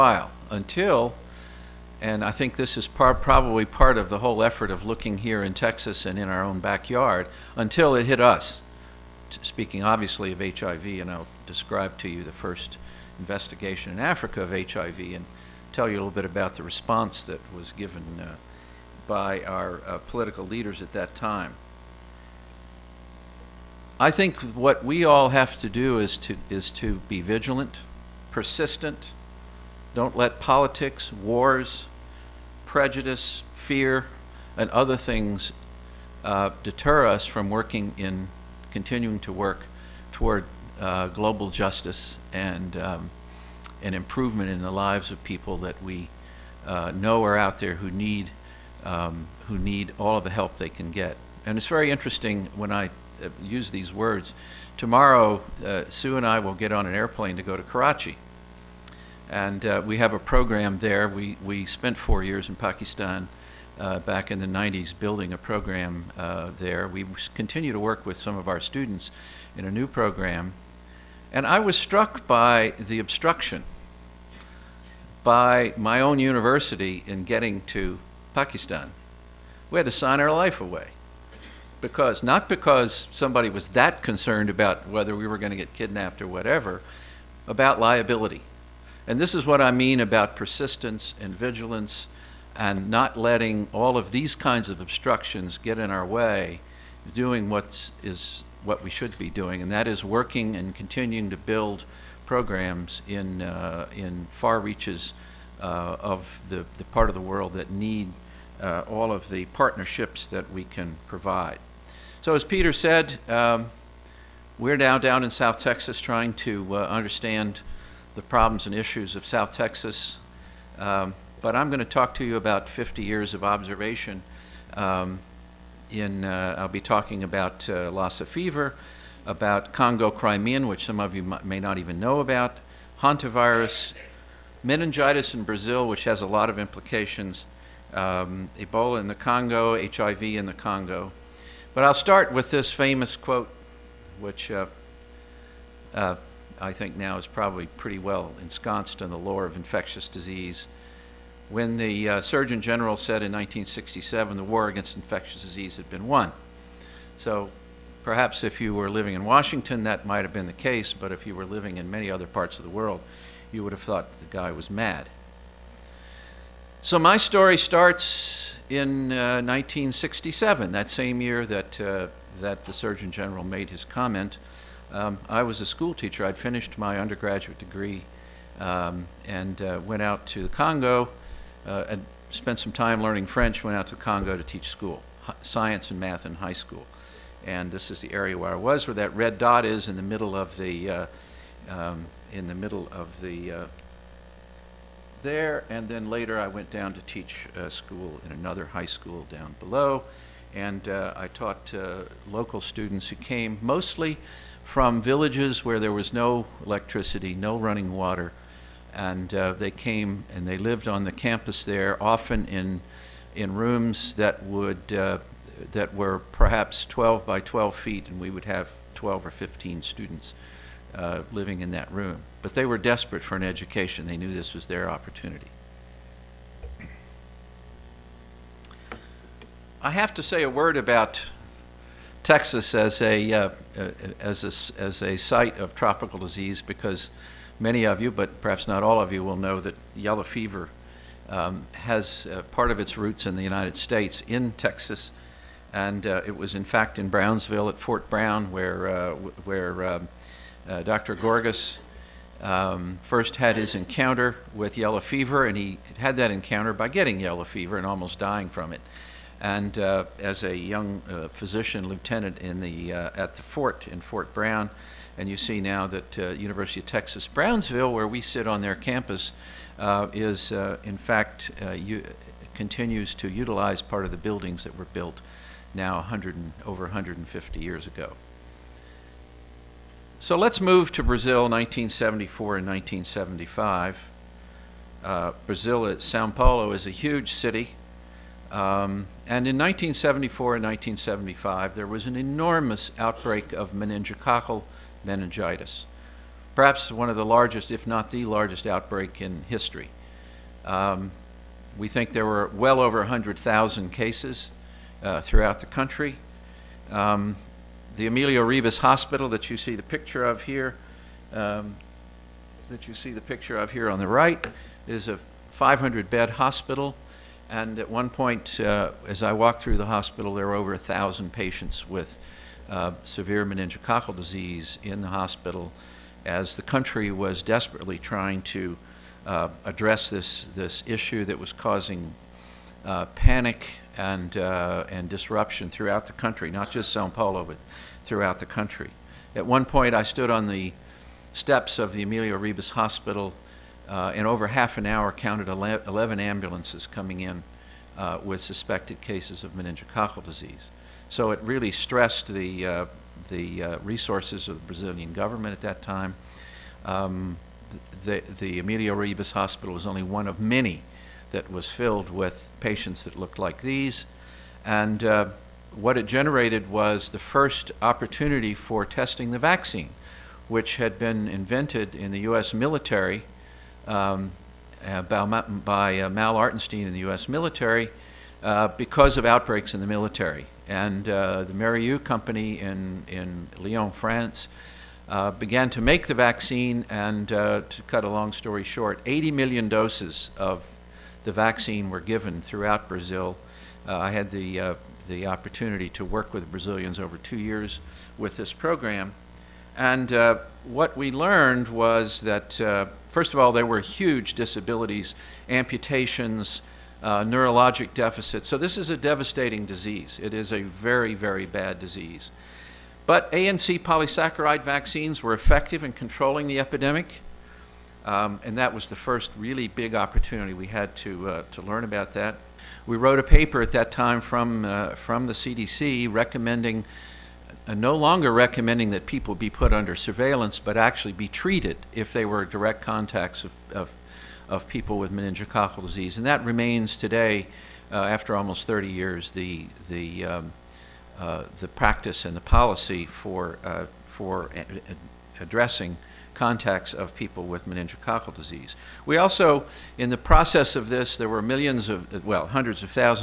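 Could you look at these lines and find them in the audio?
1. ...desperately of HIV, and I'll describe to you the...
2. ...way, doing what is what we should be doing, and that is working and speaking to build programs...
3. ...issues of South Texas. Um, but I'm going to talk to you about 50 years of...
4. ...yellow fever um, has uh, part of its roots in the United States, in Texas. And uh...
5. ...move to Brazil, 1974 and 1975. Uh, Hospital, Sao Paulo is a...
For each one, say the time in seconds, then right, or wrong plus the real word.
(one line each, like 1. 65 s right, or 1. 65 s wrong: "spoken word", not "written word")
1. 9 s wrong: "obviously", not "desperately"
2. 96 s wrong: "continuing", not "speaking"
3. 118 s right
4. 239 s right
5. 280 s wrong: "Brazil", not "Hospital".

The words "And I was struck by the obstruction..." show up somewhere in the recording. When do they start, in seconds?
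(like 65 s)
71 s.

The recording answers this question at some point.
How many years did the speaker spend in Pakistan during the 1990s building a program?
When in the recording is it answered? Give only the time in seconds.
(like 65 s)
61 s.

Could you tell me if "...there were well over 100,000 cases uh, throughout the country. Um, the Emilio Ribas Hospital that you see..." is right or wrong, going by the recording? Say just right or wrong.
right.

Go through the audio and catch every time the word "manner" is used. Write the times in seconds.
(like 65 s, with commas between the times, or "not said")
not said.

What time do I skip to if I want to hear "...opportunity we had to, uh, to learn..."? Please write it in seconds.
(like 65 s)
419 s.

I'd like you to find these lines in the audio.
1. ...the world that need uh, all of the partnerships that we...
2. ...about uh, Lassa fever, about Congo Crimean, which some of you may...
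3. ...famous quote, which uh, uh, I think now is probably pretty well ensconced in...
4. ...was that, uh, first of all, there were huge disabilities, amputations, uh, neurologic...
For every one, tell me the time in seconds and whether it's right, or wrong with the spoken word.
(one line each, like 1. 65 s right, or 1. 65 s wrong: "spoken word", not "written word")
1. 107 s right
2. 127 s right
3. 142 s right
4. 401 s right.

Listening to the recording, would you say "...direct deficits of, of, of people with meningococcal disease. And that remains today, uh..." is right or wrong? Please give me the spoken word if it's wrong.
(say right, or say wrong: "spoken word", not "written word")
wrong: "contacts", not "deficits".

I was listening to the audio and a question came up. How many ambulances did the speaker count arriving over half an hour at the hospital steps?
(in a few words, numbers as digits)
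11.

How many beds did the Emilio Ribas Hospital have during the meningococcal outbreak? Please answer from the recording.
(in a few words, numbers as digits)
500.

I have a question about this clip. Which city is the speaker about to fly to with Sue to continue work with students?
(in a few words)
Karachi.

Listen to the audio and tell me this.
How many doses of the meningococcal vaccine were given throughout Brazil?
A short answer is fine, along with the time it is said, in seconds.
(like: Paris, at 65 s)
80 million, at 389 s.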